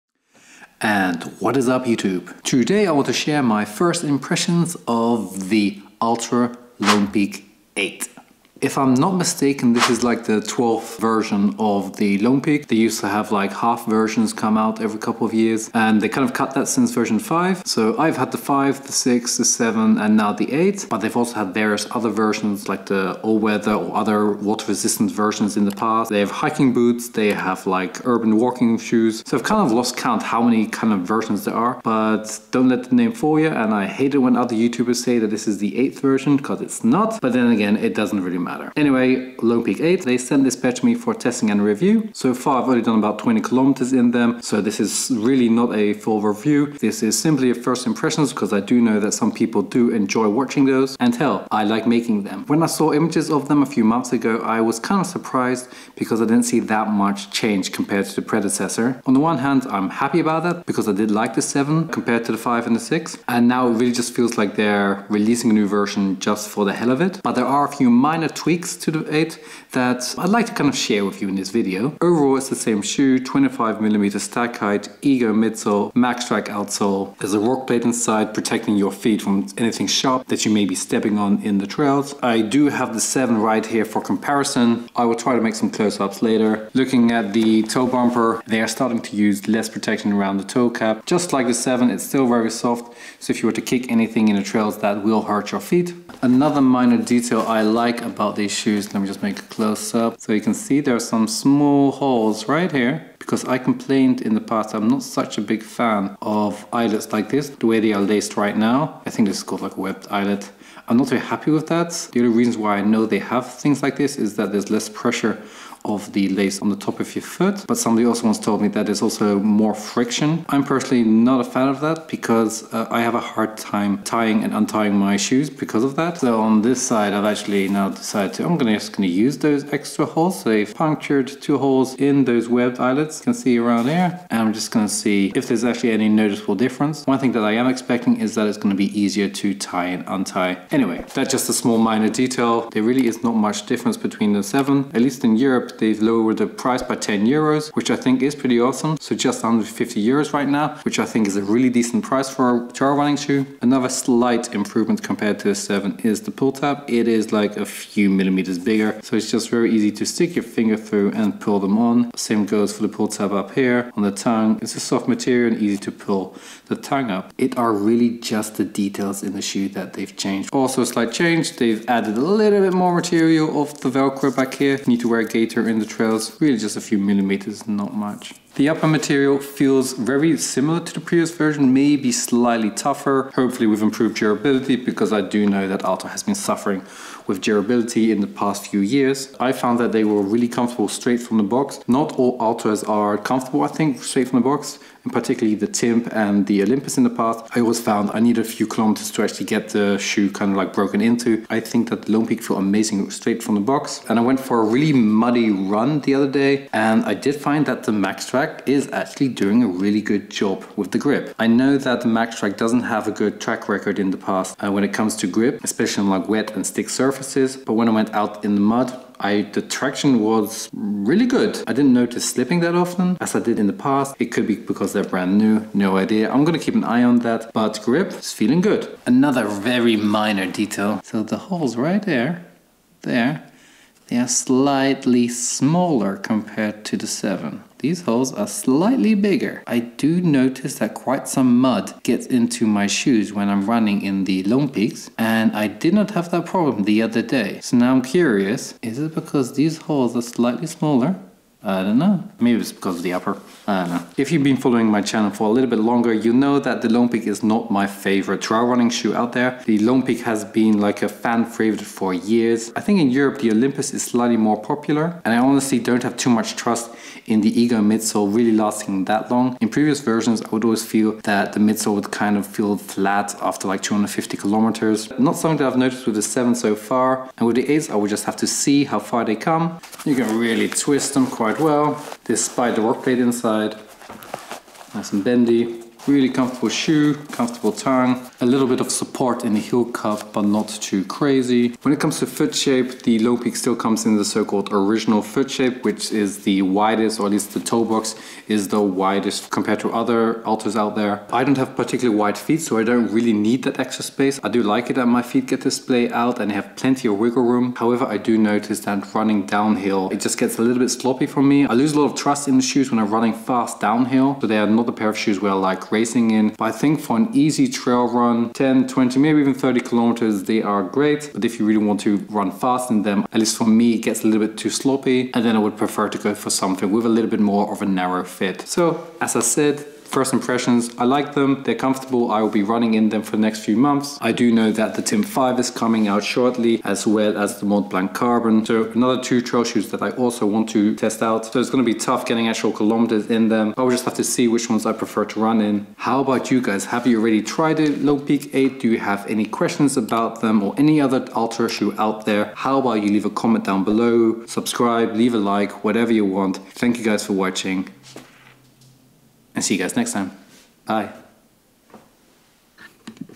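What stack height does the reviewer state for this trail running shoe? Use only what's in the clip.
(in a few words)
25mm.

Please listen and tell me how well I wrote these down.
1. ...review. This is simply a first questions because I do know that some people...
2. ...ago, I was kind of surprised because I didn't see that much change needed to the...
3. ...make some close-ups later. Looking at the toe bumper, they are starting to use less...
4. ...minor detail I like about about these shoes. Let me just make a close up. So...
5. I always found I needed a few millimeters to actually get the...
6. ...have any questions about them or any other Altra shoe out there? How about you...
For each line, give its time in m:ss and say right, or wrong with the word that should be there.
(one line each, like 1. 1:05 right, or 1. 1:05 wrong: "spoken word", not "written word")
1. 0:46 wrong: "impressions", not "questions"
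2. 0:54 wrong: "compared", not "needed"
3. 1:25 right
4. 1:36 right
5. 3:17 wrong: "kilometers", not "millimeters"
6. 5:48 right.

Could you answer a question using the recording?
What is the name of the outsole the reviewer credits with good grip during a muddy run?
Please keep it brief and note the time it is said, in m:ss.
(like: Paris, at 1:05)
MaxTrac, at 3:27.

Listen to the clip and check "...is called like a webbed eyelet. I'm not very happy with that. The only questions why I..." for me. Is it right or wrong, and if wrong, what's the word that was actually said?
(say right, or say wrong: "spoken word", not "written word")
wrong: "reasons", not "questions".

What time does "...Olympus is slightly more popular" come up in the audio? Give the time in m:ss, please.
4:23.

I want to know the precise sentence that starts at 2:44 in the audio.
It's a soft material and easy to pull the tongue up.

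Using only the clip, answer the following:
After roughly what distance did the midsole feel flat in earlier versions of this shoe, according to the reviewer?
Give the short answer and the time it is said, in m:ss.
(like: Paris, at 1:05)
250 kilometers, at 4:33.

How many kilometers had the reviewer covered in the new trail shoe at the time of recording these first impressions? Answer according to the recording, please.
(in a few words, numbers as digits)
20 kilometers.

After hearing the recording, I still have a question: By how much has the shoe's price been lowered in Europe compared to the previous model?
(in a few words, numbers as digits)
10 euros.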